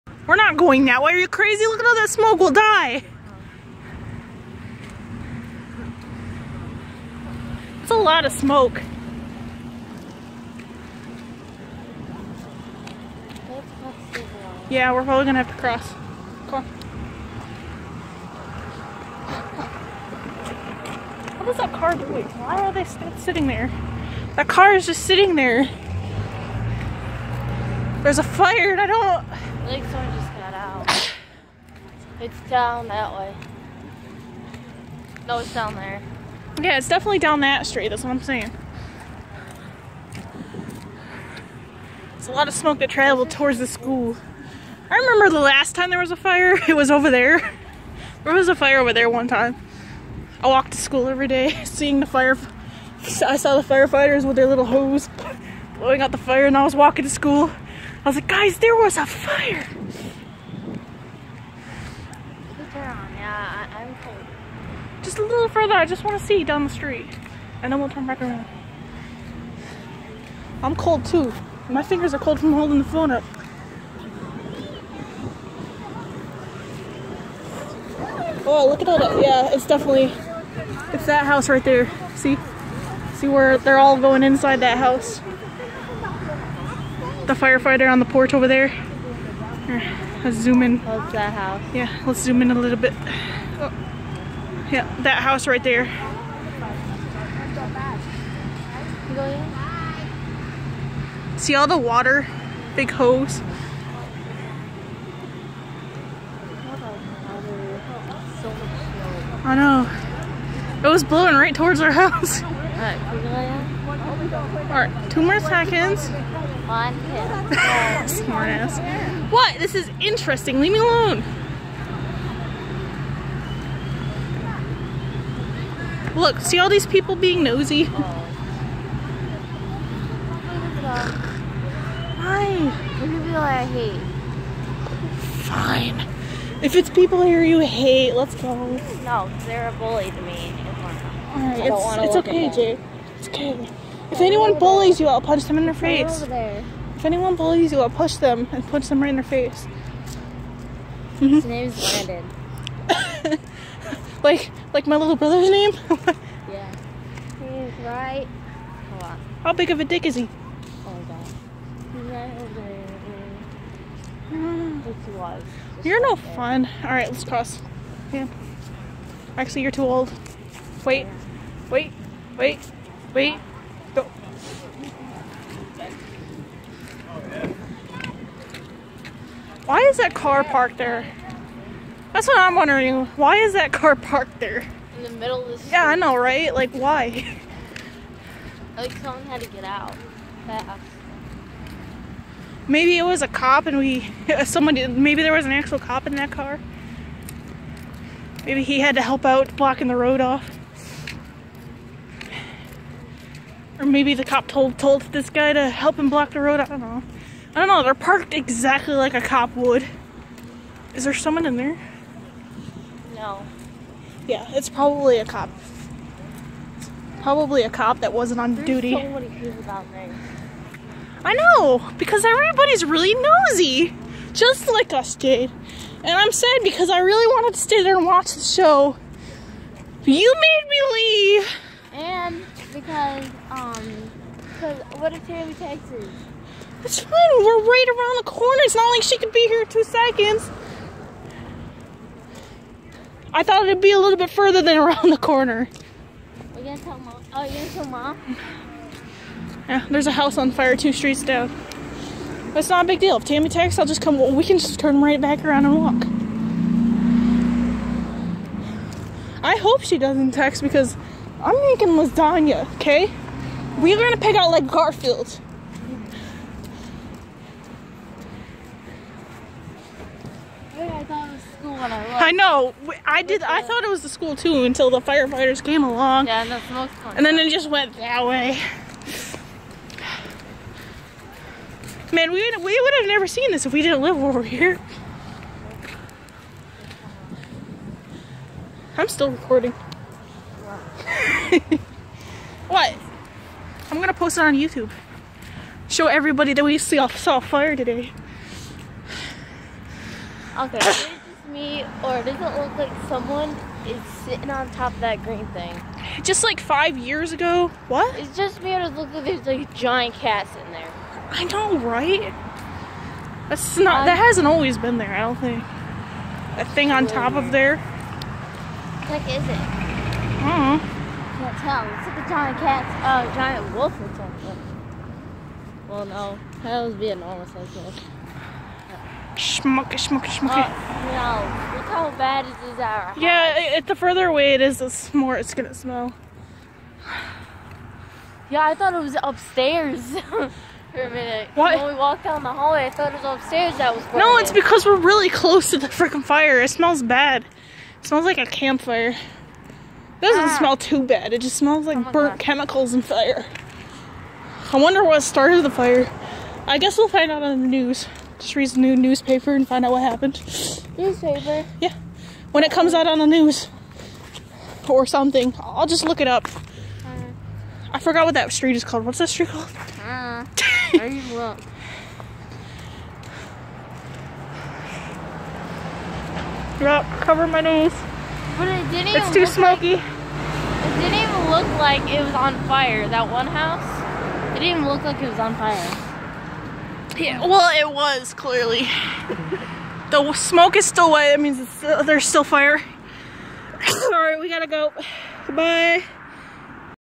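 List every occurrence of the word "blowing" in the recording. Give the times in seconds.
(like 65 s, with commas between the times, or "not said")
55 s, 111 s.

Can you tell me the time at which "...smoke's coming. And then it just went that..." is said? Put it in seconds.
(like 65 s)
276 s.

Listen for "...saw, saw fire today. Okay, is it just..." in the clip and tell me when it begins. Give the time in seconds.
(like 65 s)
296 s.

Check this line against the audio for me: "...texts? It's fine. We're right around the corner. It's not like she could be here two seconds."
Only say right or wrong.
right.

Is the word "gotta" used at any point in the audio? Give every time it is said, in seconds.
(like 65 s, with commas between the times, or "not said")
394 s.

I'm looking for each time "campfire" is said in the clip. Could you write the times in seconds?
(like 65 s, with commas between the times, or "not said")
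348 s.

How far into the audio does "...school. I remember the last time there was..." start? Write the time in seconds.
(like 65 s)
43 s.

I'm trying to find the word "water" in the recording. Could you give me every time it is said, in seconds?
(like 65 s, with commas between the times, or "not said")
101 s.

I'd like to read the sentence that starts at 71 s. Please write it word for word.
My fingers are cold from holding the phone up.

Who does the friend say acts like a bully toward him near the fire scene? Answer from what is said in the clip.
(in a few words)
Brandon.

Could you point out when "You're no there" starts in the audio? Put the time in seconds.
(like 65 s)
165 s.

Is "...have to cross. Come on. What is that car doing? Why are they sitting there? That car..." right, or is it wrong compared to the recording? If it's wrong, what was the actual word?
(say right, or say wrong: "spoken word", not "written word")
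right.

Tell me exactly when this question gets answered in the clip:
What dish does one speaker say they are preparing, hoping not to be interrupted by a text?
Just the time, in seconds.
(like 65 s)
261 s.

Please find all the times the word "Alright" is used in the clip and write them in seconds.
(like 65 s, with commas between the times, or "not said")
114 s, 141 s.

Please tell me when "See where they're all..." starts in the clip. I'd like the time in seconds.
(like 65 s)
83 s.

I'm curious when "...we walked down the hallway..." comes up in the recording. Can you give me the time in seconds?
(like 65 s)
341 s.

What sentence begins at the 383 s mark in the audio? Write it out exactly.
That one house, it didn't even look like it was on fire.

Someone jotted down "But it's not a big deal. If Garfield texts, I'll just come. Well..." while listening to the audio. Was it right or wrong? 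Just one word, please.
wrong.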